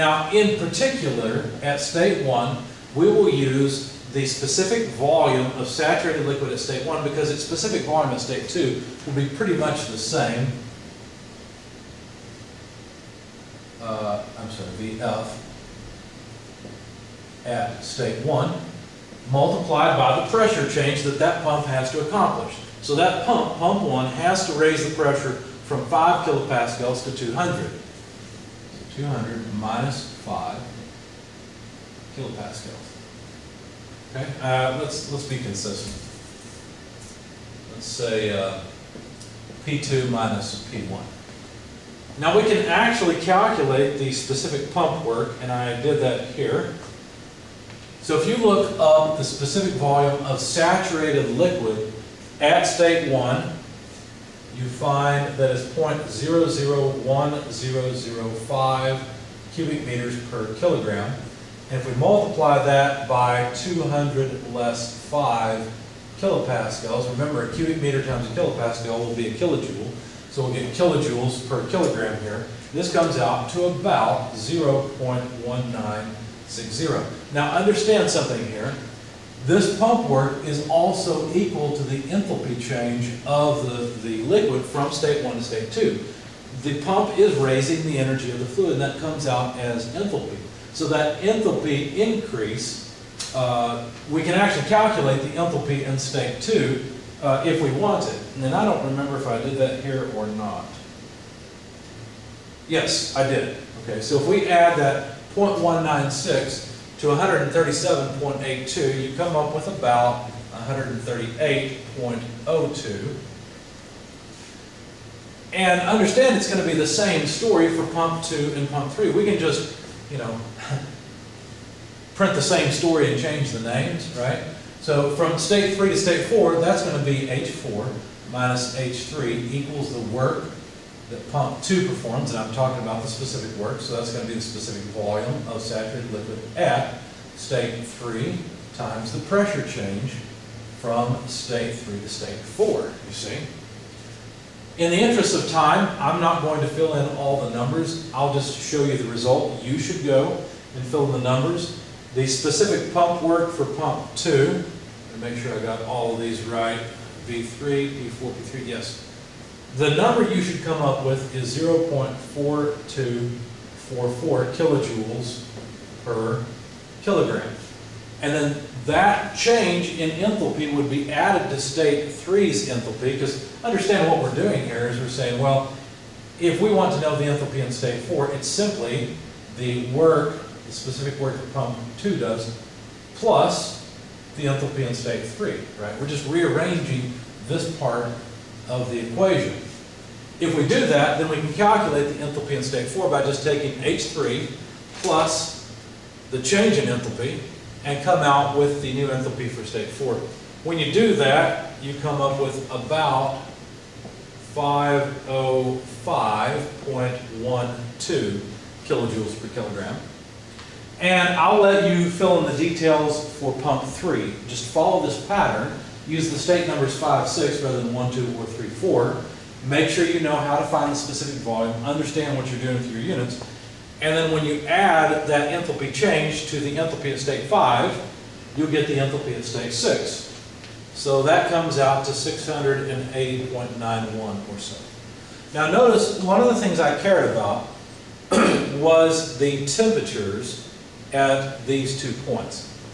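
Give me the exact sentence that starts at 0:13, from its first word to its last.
Uh, I'm sorry, VF at state one multiplied by the pressure change that that pump has to accomplish.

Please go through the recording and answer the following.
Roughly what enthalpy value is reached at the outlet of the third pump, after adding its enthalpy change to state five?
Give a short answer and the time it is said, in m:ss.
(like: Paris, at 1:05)
680.91, at 3:52.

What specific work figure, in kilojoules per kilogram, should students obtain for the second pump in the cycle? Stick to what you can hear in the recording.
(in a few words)
0.4244.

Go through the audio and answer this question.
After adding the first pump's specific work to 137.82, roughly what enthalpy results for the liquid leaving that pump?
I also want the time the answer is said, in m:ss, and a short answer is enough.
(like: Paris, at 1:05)
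138.02, at 1:50.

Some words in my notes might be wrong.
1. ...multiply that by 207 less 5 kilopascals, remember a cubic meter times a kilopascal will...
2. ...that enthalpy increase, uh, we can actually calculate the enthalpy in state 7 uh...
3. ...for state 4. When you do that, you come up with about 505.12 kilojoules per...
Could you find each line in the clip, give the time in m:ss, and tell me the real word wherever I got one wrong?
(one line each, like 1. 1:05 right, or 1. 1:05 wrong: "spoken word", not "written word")
1. 1:01 wrong: "200", not "207"
2. 1:30 wrong: "2", not "7"
3. 3:19 right.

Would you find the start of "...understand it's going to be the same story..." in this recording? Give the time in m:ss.
1:55.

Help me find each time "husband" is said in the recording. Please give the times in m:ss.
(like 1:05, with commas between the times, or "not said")
not said.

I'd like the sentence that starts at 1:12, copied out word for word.
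This comes out to about 0.1960.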